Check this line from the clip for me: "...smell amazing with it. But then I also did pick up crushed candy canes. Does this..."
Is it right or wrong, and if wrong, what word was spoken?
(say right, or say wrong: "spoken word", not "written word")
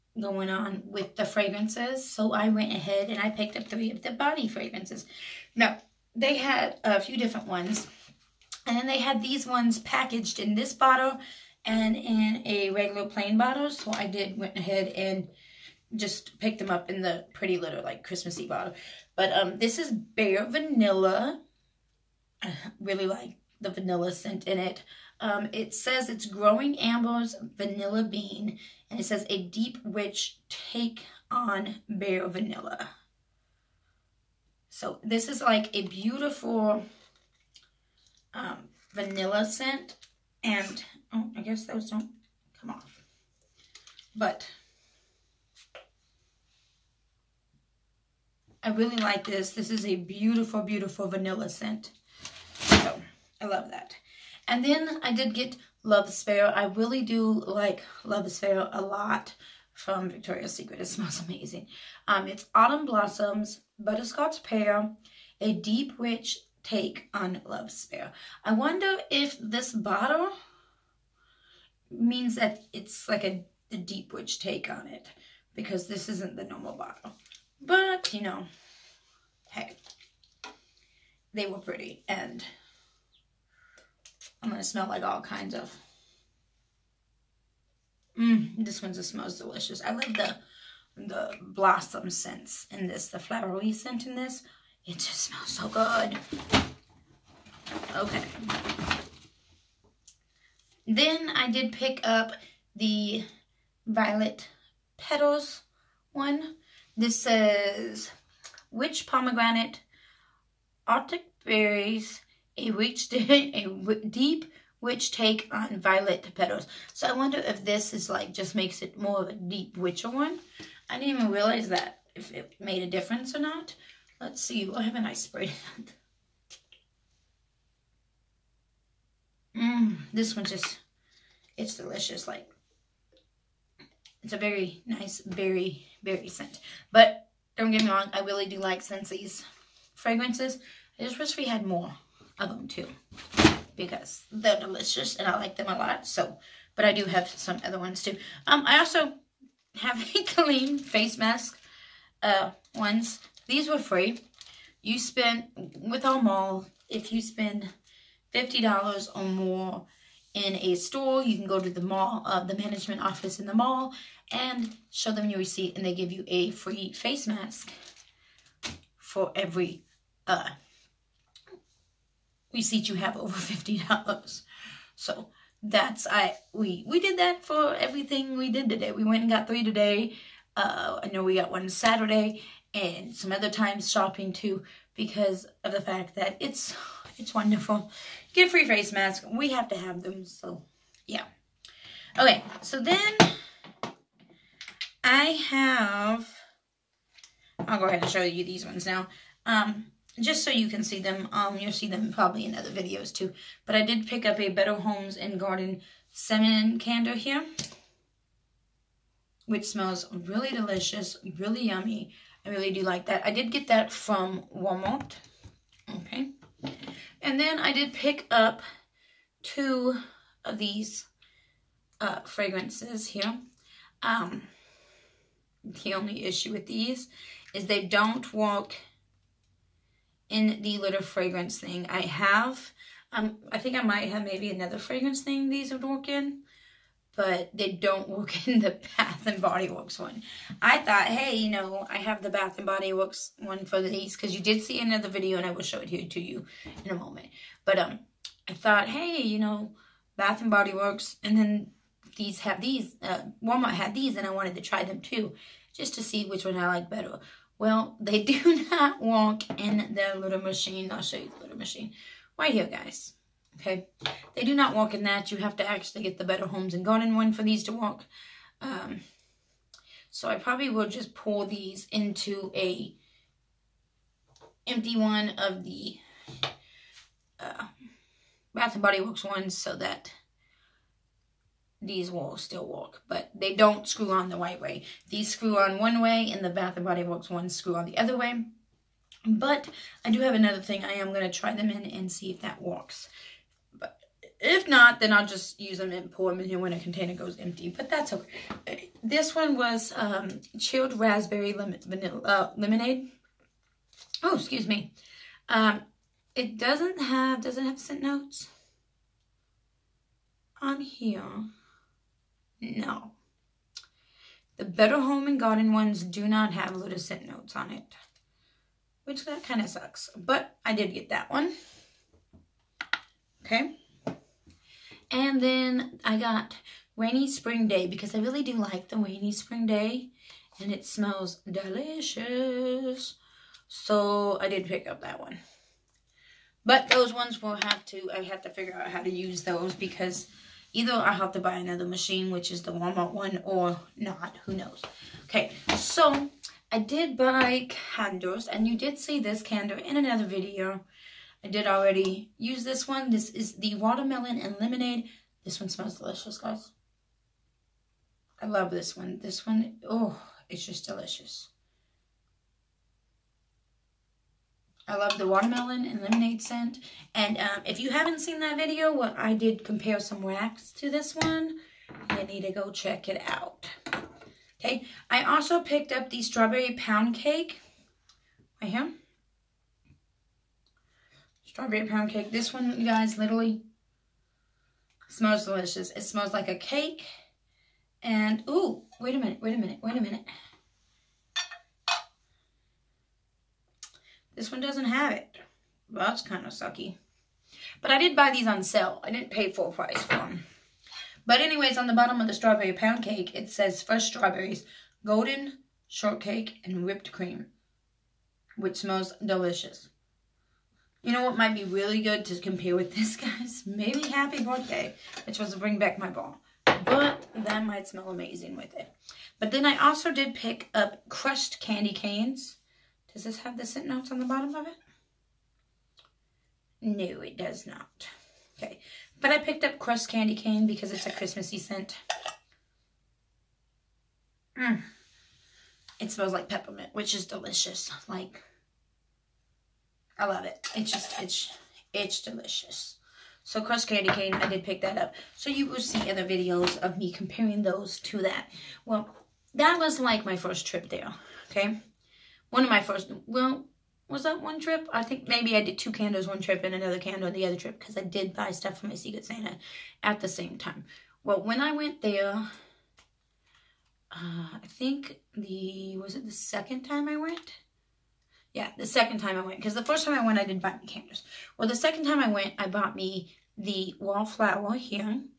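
right.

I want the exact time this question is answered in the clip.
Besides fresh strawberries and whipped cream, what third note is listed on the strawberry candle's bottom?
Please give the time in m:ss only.
6:45.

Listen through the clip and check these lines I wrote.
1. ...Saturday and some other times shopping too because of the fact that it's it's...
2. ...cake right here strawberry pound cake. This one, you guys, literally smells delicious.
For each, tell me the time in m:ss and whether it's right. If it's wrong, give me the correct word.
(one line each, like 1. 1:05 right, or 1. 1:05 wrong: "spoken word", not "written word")
1. 3:01 right
2. 6:17 right.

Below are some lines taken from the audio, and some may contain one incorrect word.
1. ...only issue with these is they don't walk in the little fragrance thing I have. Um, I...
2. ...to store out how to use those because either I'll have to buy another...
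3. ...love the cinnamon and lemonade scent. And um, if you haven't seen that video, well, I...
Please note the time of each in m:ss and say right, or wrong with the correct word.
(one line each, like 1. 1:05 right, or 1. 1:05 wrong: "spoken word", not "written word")
1. 3:45 right
2. 5:38 wrong: "figure", not "store"
3. 6:04 wrong: "watermelon", not "cinnamon".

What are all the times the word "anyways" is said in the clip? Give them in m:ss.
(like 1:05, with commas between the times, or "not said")
6:41.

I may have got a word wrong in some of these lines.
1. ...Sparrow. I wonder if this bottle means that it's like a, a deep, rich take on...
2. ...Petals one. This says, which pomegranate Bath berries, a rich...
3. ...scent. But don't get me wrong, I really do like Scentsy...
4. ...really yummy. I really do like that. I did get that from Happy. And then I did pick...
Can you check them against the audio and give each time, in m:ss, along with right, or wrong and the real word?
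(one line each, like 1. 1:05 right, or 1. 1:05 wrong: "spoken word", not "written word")
1. 1:07 right
2. 1:44 wrong: "Arctic", not "Bath"
3. 2:16 right
4. 3:31 wrong: "Walmart", not "Happy".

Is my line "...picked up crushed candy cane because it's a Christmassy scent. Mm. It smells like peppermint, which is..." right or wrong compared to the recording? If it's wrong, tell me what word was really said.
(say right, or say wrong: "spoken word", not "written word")
right.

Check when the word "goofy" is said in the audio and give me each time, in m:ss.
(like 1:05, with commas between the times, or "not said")
not said.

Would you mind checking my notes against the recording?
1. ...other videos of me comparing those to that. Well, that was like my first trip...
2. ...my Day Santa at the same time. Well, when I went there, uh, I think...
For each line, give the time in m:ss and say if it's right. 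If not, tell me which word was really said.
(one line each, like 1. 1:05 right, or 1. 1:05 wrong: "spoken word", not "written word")
1. 7:26 right
2. 7:38 wrong: "Secret", not "Day".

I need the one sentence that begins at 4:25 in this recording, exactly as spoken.
You have to actually get the Better Homes and Garden one for these to walk.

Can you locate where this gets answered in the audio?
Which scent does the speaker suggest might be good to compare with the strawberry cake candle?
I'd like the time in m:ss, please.
6:54.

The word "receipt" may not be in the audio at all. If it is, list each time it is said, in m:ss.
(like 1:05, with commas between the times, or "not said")
2:45, 2:52.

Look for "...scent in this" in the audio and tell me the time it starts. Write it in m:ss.
1:33.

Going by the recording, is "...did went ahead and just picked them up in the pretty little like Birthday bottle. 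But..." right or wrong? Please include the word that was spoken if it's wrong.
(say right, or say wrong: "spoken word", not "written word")
wrong: "Christmassy", not "Birthday".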